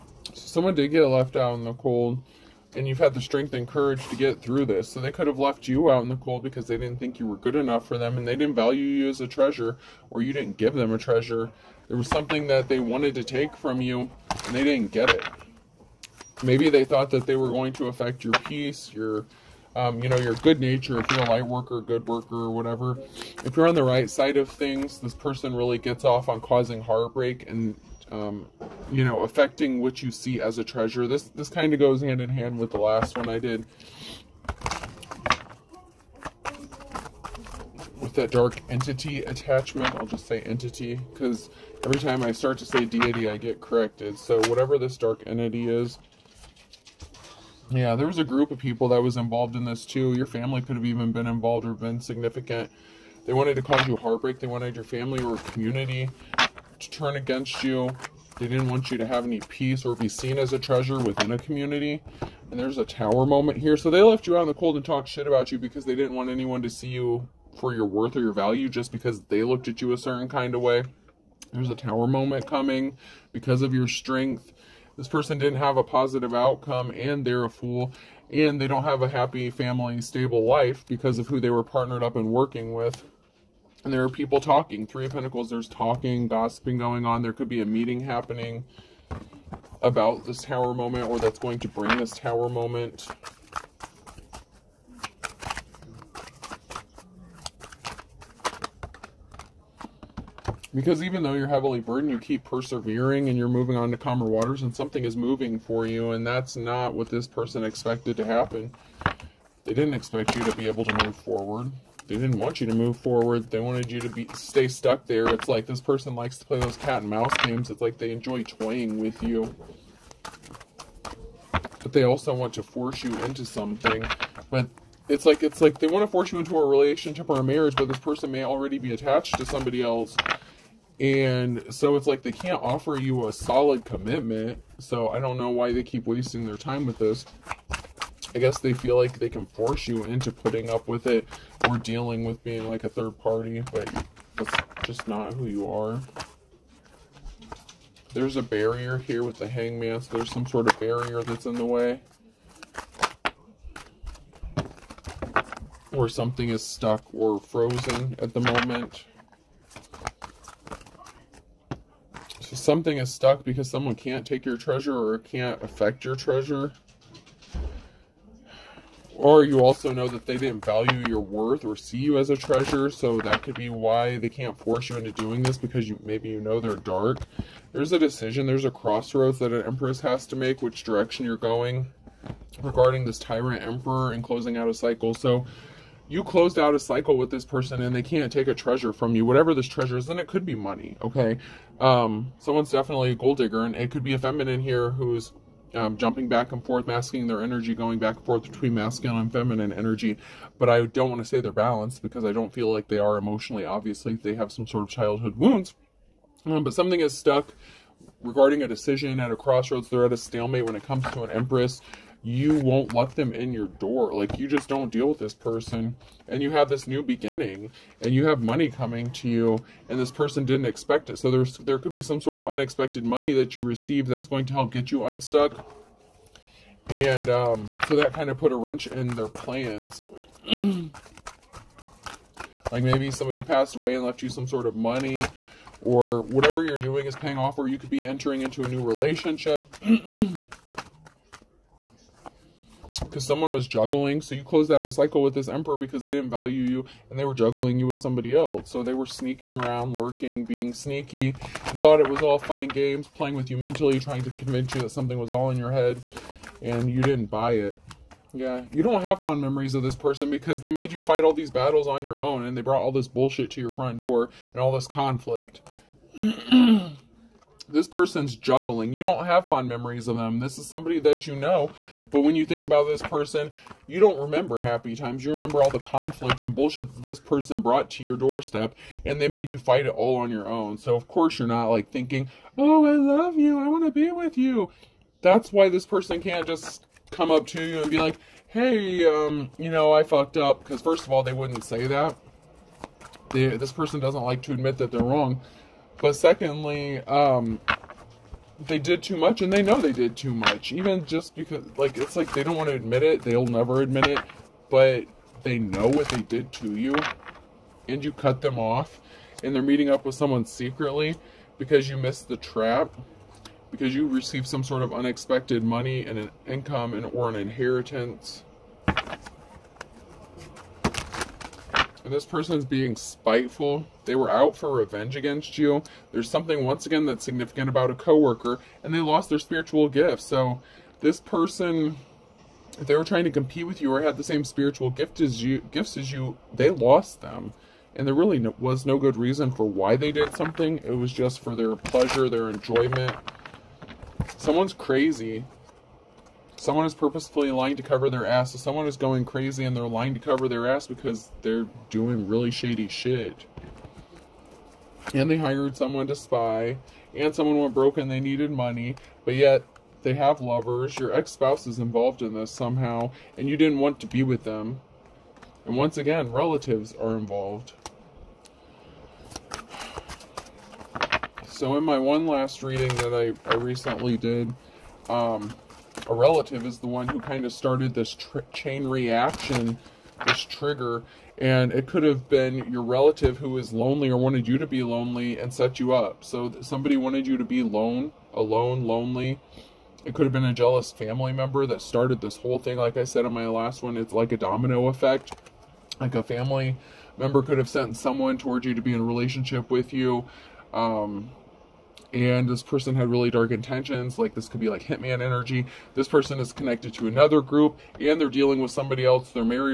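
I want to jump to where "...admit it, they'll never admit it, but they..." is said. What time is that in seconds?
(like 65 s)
302 s.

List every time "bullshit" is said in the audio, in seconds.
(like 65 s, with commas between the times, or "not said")
263 s, 276 s.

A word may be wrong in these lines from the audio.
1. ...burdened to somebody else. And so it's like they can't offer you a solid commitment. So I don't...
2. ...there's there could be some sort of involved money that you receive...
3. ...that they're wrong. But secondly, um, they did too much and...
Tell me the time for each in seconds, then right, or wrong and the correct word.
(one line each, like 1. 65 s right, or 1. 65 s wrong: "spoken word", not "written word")
1. 128 s wrong: "attached", not "burdened"
2. 221 s wrong: "unexpected", not "involved"
3. 294 s right.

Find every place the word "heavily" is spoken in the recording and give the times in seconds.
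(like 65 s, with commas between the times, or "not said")
101 s.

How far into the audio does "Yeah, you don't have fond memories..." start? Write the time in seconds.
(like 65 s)
258 s.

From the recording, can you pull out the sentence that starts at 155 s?
Or something is stuck or frozen at the moment.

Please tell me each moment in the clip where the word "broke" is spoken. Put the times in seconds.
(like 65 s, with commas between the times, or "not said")
357 s.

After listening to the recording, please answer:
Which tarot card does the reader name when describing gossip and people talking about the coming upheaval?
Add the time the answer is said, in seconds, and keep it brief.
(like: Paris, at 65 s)
Three of Pentacles, at 84 s.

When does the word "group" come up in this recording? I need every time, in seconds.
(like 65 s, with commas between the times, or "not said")
48 s, 407 s.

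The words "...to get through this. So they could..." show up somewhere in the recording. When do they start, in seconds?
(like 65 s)
4 s.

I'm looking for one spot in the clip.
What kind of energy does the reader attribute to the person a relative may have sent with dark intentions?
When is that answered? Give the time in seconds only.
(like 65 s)
404 s.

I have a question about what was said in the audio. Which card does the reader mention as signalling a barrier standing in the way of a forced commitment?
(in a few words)
The hangman.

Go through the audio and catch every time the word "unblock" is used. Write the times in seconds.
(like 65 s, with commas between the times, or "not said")
not said.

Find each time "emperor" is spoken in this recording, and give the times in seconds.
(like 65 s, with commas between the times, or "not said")
183 s, 245 s.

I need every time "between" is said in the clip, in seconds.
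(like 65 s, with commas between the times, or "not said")
198 s.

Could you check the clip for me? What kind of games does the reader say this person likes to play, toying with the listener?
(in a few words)
Cat and mouse.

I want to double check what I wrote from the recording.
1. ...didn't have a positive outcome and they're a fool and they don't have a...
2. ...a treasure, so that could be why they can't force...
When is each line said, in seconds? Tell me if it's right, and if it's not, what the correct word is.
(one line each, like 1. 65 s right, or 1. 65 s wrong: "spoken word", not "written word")
1. 75 s right
2. 172 s right.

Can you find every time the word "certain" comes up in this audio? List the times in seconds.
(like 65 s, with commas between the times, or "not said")
69 s.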